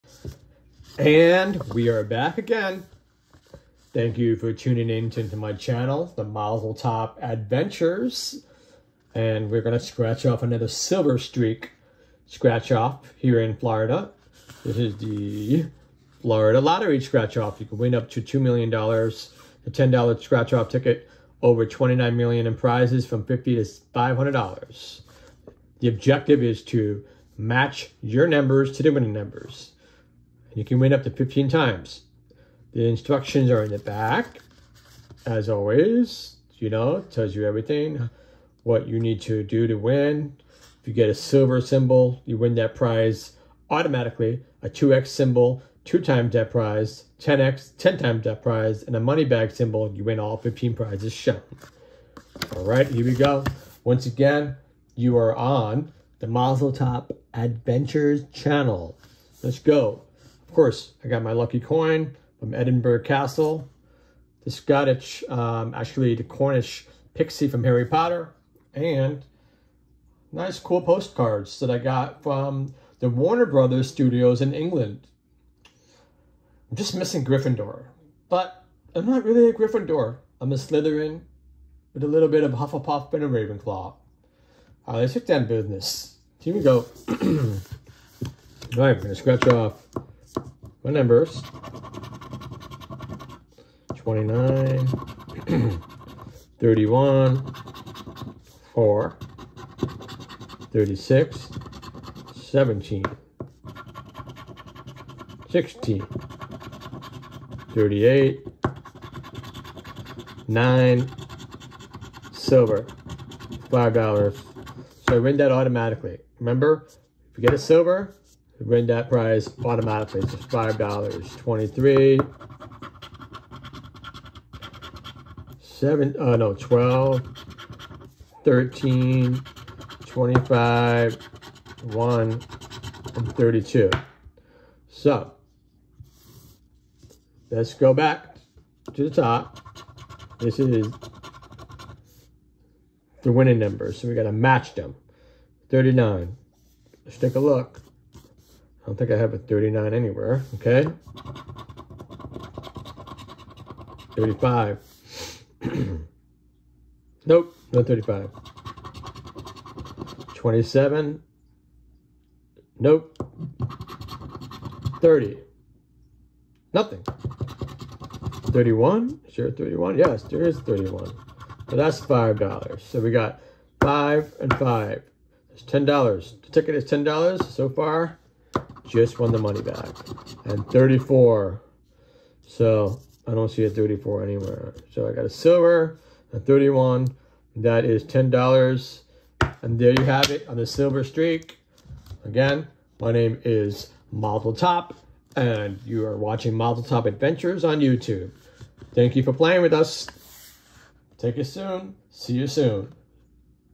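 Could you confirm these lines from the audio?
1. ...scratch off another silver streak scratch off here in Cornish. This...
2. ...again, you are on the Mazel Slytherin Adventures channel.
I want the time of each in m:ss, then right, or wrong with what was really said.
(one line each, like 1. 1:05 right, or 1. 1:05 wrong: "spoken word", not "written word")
1. 0:09 wrong: "Florida", not "Cornish"
2. 0:54 wrong: "Top", not "Slytherin".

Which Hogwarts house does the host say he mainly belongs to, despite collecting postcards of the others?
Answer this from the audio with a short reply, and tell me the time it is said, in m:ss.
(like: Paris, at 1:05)
Slytherin, at 1:20.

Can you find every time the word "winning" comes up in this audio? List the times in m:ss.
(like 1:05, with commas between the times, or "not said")
0:28, 2:23.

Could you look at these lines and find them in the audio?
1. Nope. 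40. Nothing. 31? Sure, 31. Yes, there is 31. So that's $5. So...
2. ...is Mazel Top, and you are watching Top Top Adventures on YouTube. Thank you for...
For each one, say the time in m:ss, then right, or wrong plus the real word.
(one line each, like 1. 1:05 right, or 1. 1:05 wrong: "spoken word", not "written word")
1. 2:42 wrong: "30", not "40"
2. 3:13 wrong: "Mazel", not "Top".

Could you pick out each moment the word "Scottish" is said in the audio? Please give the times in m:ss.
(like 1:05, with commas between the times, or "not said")
1:04.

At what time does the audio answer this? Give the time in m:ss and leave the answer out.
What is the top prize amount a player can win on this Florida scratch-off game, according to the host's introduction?
0:18.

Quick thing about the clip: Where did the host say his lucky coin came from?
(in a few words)
Edinburgh Castle.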